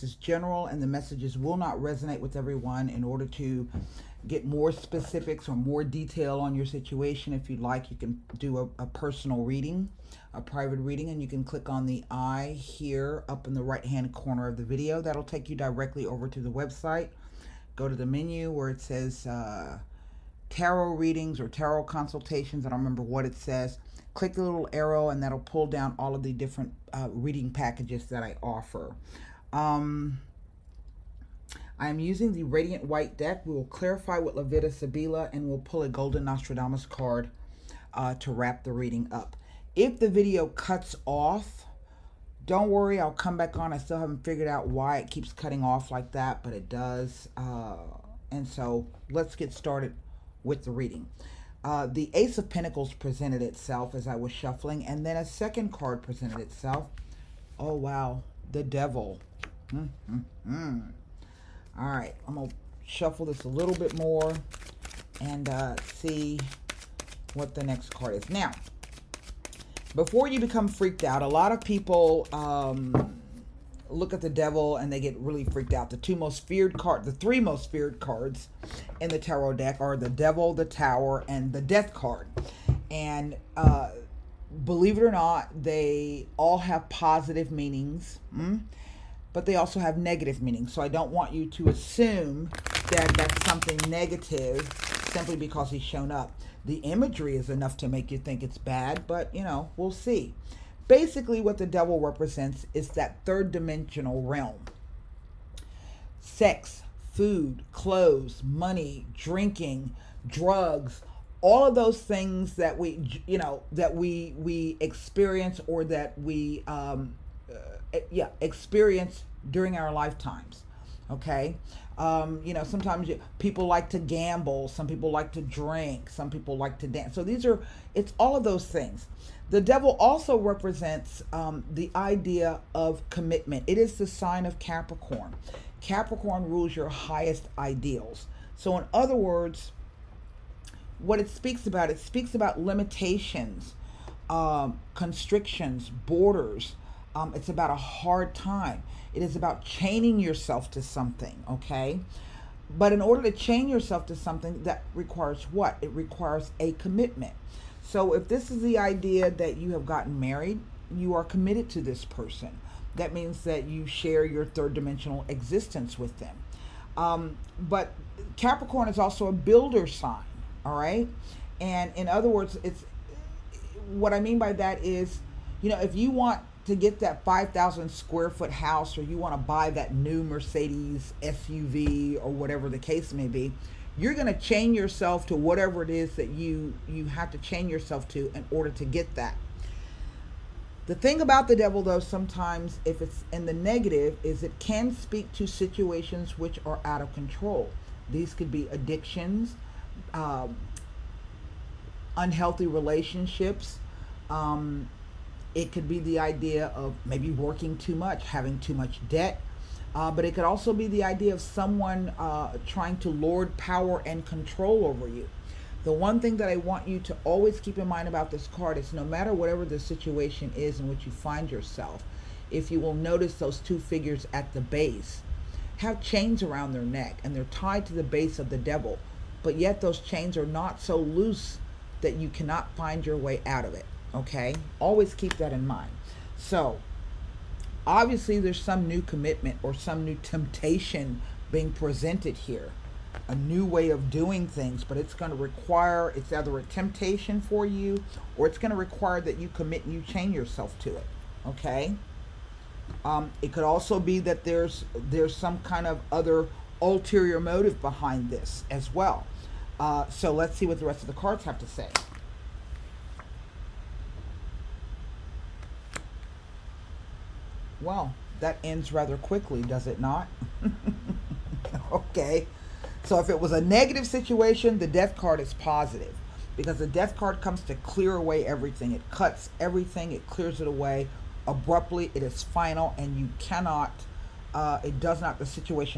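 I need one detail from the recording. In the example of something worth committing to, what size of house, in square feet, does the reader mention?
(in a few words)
5,000.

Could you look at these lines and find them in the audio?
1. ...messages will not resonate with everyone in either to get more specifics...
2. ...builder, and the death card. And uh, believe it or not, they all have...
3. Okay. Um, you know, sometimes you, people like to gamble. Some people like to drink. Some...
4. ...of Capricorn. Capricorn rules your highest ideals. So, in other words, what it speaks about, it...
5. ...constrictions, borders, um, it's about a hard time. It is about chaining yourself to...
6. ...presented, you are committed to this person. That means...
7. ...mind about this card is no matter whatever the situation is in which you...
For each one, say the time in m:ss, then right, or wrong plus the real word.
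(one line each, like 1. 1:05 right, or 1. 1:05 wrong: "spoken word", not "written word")
1. 0:00 wrong: "order", not "either"
2. 1:20 wrong: "tower", not "builder"
3. 2:01 right
4. 2:14 right
5. 2:24 right
6. 2:40 wrong: "married", not "presented"
7. 3:37 right.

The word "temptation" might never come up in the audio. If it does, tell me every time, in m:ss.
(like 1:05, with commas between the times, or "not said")
4:00, 4:06.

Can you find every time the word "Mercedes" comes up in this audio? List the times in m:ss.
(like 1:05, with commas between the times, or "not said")
3:00.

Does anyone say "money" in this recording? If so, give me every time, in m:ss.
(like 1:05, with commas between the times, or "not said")
1:48.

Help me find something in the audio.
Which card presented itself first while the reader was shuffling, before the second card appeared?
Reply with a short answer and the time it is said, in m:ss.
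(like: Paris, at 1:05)
Ace of Pentacles, at 0:52.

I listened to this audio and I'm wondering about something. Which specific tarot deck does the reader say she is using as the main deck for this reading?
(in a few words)
Radiant Waite.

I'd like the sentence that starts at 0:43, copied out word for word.
I still haven't figured out why it keeps cutting off like that, but it does.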